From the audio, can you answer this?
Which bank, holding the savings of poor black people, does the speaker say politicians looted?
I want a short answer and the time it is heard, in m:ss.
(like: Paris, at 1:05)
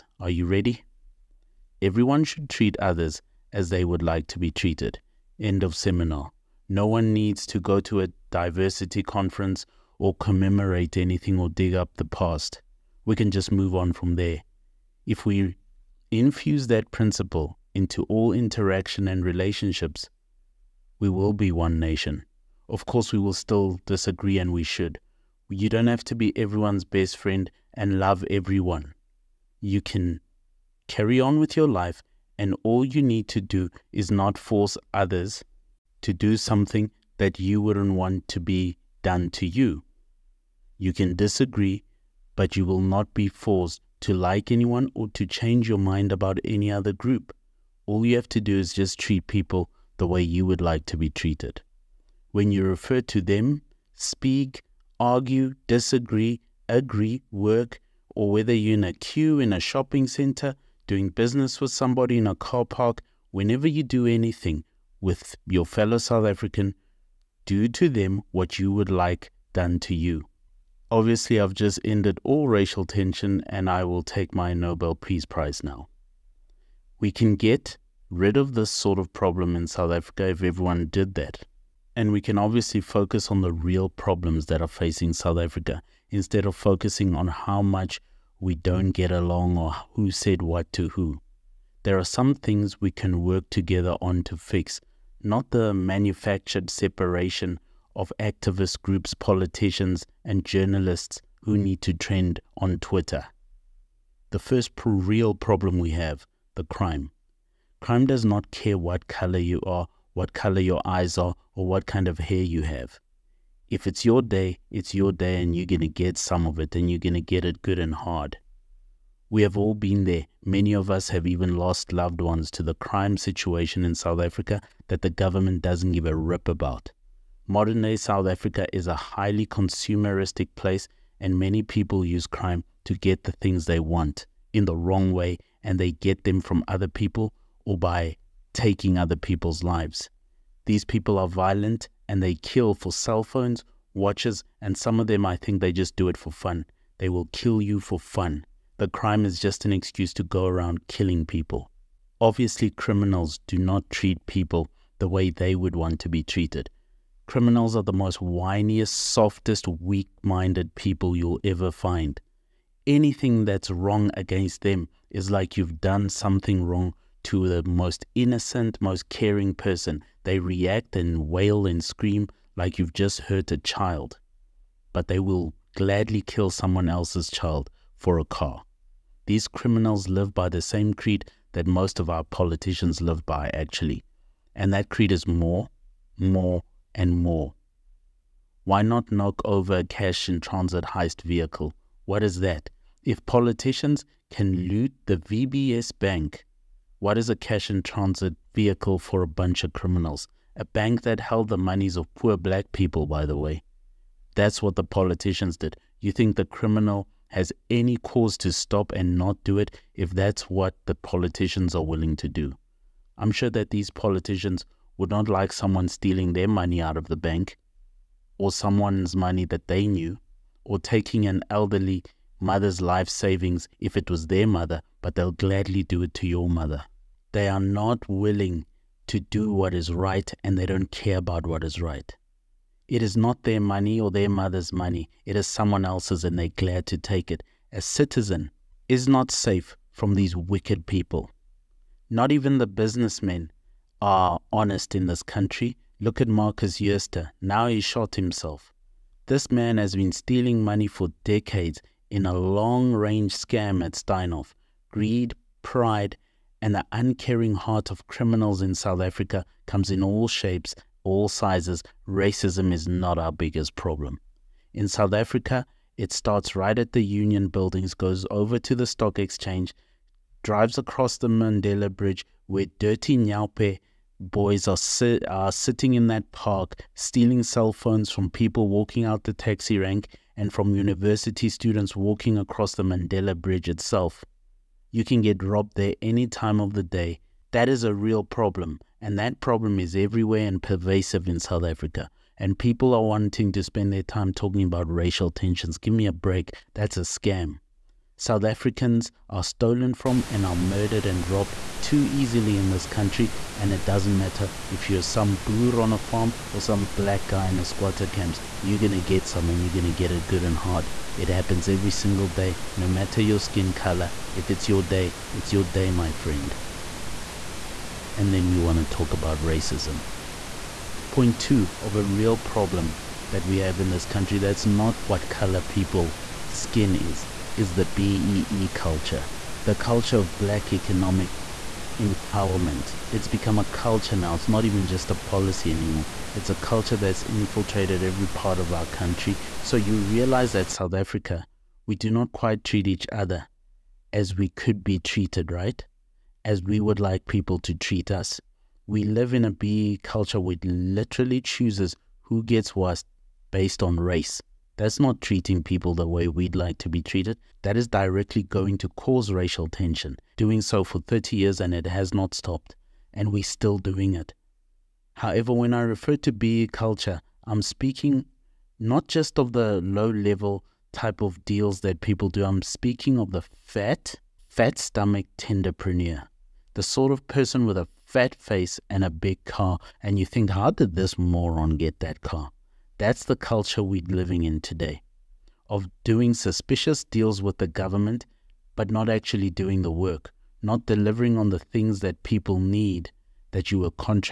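VBS bank, at 3:15.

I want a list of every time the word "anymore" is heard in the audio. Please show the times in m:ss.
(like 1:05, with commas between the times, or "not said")
5:35.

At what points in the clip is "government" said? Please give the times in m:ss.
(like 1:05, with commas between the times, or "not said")
2:05, 6:27.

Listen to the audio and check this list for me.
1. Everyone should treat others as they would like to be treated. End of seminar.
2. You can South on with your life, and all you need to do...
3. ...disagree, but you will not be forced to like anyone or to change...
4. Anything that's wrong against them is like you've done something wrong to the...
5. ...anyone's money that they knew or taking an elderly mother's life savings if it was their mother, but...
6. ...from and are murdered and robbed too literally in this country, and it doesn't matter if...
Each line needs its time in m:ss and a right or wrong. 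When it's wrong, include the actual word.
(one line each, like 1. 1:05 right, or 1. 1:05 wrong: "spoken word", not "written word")
1. 0:01 right
2. 0:29 wrong: "Carry", not "South"
3. 0:41 right
4. 2:42 right
5. 3:38 wrong: "someone", not "anyone"
6. 4:59 wrong: "easily", not "literally".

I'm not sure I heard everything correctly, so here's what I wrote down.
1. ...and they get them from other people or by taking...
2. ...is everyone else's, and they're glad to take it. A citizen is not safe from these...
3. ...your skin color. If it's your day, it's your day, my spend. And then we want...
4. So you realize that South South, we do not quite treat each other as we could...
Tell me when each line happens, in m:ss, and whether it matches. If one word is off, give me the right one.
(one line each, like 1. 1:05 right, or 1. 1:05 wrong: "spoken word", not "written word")
1. 2:15 right
2. 3:55 wrong: "someone", not "everyone"
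3. 5:13 wrong: "friend", not "spend"
4. 5:39 wrong: "Africa", not "South".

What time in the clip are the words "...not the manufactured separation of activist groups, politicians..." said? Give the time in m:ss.
1:35.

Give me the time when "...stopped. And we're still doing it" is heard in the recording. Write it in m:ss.
6:02.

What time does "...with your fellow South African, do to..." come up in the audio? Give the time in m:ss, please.
1:04.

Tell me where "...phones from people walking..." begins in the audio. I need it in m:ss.
4:37.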